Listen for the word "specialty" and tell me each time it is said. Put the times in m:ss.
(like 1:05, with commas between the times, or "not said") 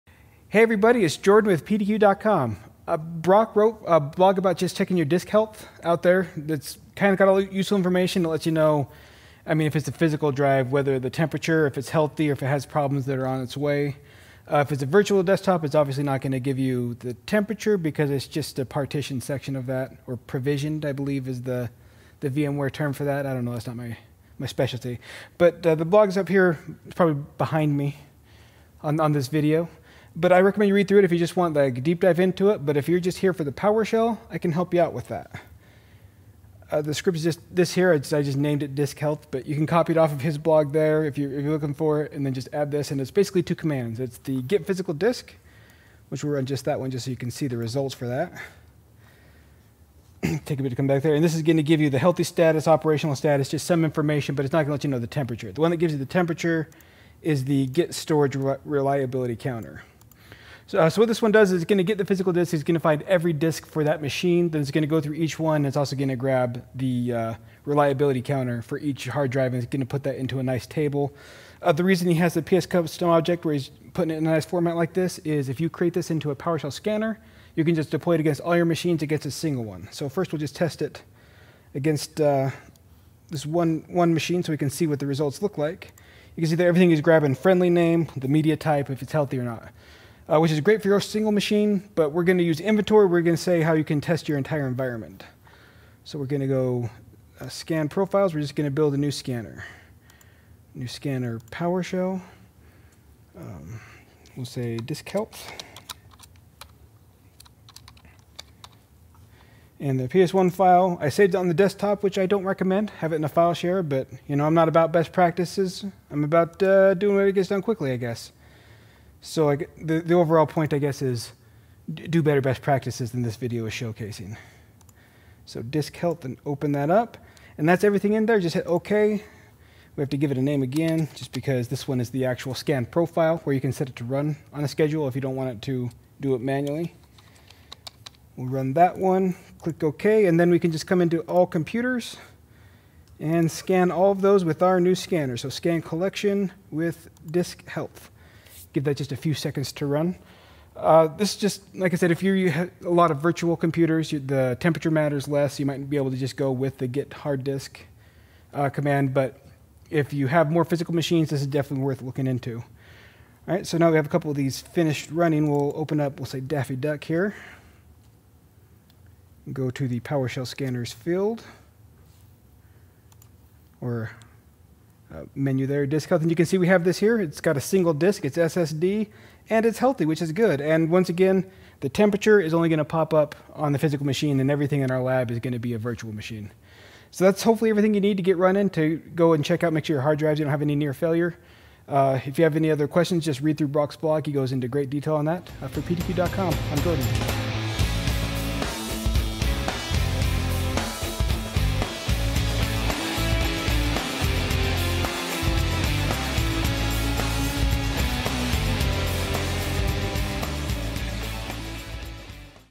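0:24.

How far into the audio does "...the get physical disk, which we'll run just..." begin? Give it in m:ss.
0:44.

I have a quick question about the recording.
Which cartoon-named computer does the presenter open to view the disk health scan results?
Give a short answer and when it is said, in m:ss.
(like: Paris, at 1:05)
Daffy Duck, at 2:46.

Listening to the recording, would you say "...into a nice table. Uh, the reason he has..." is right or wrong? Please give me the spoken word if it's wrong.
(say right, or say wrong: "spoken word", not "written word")
right.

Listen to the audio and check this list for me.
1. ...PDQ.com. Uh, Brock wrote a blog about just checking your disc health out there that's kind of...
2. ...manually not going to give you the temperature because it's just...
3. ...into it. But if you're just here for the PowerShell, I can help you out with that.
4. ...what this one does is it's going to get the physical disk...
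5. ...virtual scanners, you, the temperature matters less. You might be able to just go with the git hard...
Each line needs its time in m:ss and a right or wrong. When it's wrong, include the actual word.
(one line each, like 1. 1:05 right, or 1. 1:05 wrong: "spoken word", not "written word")
1. 0:01 right
2. 0:15 wrong: "obviously", not "manually"
3. 0:32 right
4. 1:01 right
5. 2:33 wrong: "computers", not "scanners".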